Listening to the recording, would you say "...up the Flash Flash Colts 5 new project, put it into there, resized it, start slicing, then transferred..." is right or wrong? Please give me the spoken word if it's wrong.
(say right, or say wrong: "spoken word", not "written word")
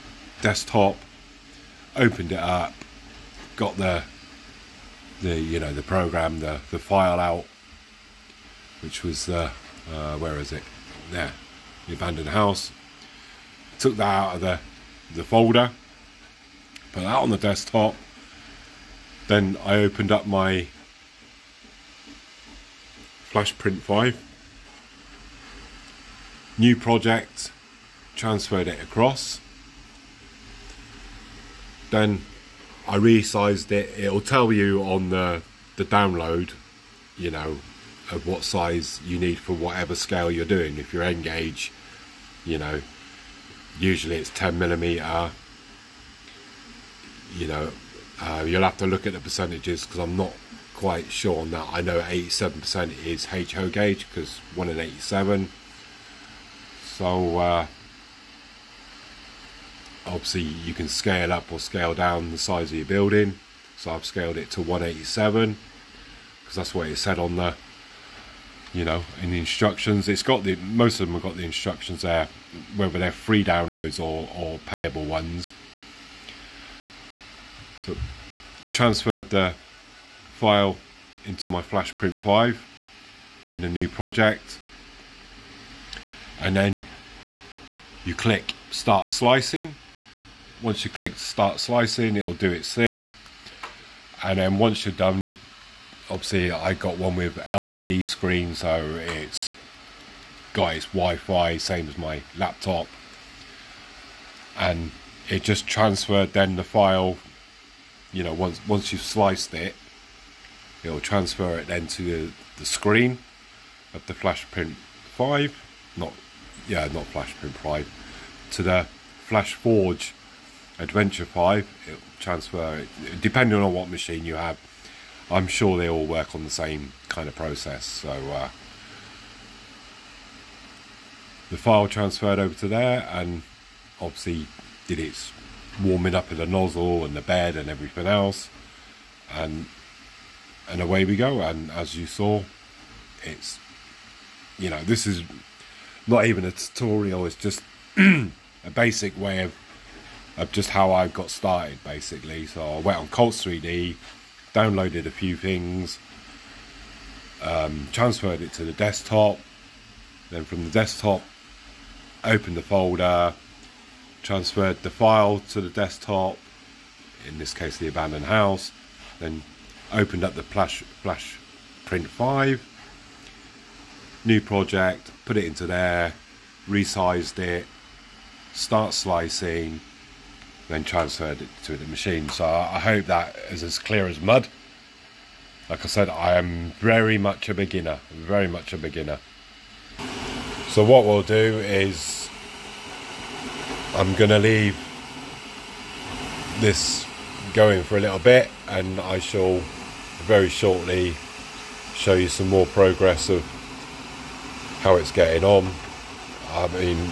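wrong: "Print", not "Colts".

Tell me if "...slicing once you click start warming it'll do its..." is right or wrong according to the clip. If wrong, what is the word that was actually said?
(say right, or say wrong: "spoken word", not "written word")
wrong: "slicing", not "warming".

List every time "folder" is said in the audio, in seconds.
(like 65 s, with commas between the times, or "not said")
15 s, 162 s.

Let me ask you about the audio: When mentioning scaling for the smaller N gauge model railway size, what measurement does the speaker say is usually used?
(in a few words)
10 millimeter.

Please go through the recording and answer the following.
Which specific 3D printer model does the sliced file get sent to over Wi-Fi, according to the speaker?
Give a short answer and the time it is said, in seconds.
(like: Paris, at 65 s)
Flash Forge Adventure 5, at 119 s.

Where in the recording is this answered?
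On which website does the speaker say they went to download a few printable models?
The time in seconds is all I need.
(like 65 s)
153 s.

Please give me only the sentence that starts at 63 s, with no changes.
So I've scaled it to 187 because that's what it said on the, you know, in the instructions.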